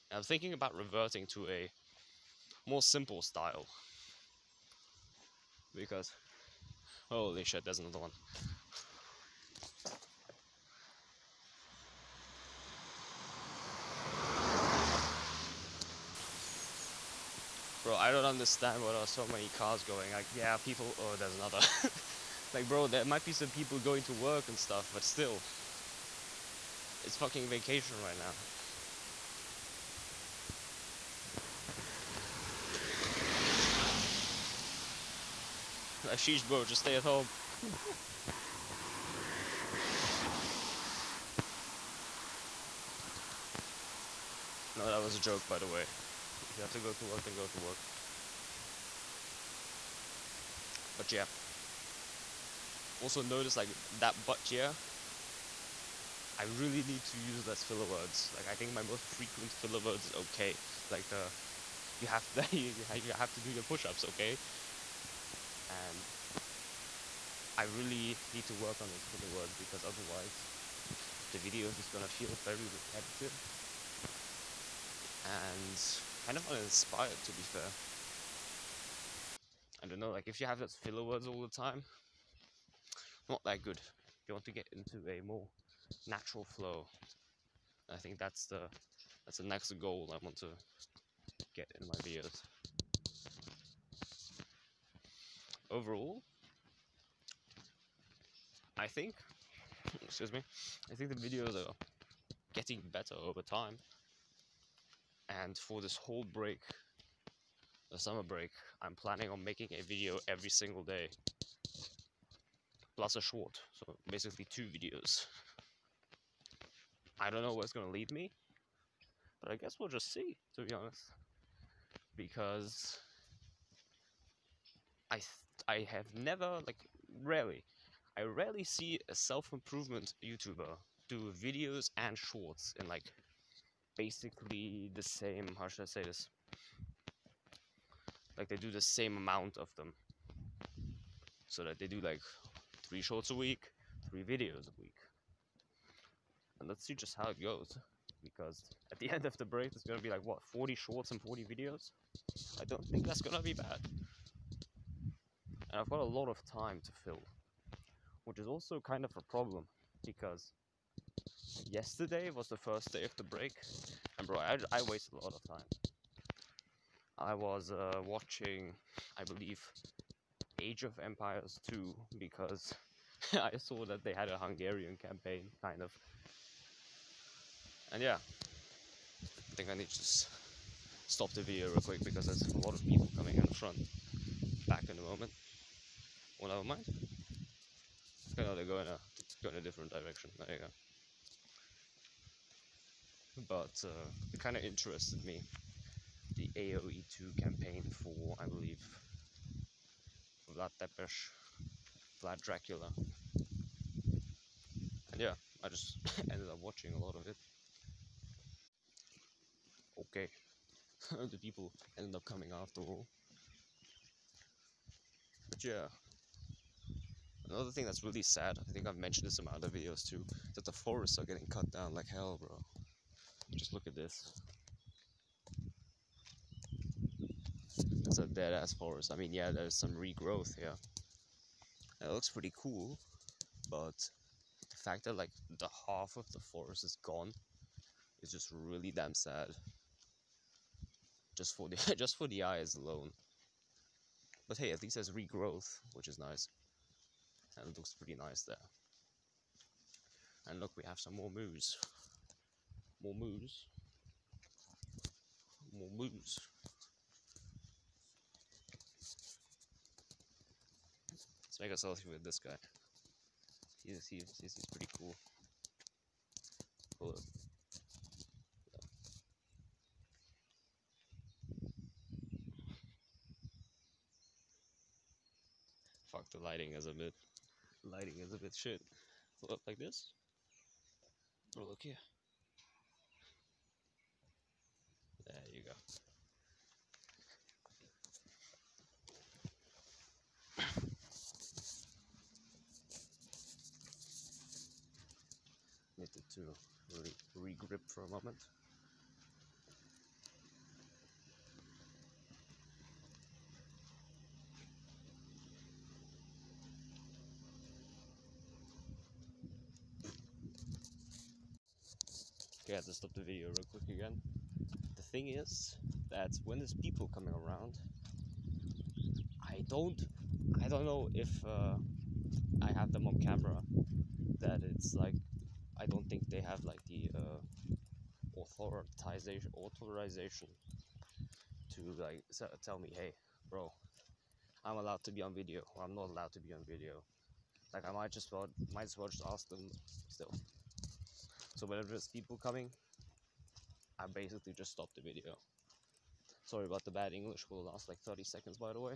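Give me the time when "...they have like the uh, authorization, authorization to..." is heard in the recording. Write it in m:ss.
5:26.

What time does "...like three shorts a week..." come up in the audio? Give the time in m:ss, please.
2:21.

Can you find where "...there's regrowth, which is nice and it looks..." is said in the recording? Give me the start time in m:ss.
4:04.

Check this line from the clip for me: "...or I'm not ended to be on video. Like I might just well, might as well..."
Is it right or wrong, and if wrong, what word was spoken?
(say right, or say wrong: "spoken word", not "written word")
wrong: "allowed", not "ended".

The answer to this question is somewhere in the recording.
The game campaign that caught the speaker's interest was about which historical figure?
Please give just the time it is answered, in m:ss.
3:20.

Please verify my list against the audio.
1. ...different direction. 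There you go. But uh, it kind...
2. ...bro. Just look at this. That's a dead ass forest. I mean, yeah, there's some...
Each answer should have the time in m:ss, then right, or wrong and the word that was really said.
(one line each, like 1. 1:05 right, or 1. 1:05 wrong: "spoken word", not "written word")
1. 3:09 right
2. 3:42 right.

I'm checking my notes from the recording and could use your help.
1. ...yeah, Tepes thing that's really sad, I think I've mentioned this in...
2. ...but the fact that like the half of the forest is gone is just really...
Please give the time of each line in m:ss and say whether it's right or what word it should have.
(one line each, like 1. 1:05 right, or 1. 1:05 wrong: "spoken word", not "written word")
1. 3:35 wrong: "Another", not "Tepes"
2. 3:53 right.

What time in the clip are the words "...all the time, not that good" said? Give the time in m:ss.
1:21.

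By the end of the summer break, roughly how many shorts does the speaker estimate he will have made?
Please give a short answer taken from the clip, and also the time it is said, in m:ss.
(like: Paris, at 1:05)
40, at 2:30.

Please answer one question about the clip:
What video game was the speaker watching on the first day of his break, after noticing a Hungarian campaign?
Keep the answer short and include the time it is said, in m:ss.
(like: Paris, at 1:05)
Age of Empires 2, at 2:50.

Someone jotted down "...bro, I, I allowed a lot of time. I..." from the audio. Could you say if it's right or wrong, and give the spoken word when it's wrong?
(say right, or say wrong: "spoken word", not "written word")
wrong: "wasted", not "allowed".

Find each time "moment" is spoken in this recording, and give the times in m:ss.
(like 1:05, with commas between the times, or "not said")
3:05, 4:58.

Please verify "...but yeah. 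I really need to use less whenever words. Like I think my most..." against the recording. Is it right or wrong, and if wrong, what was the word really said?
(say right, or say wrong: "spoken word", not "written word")
wrong: "filler", not "whenever".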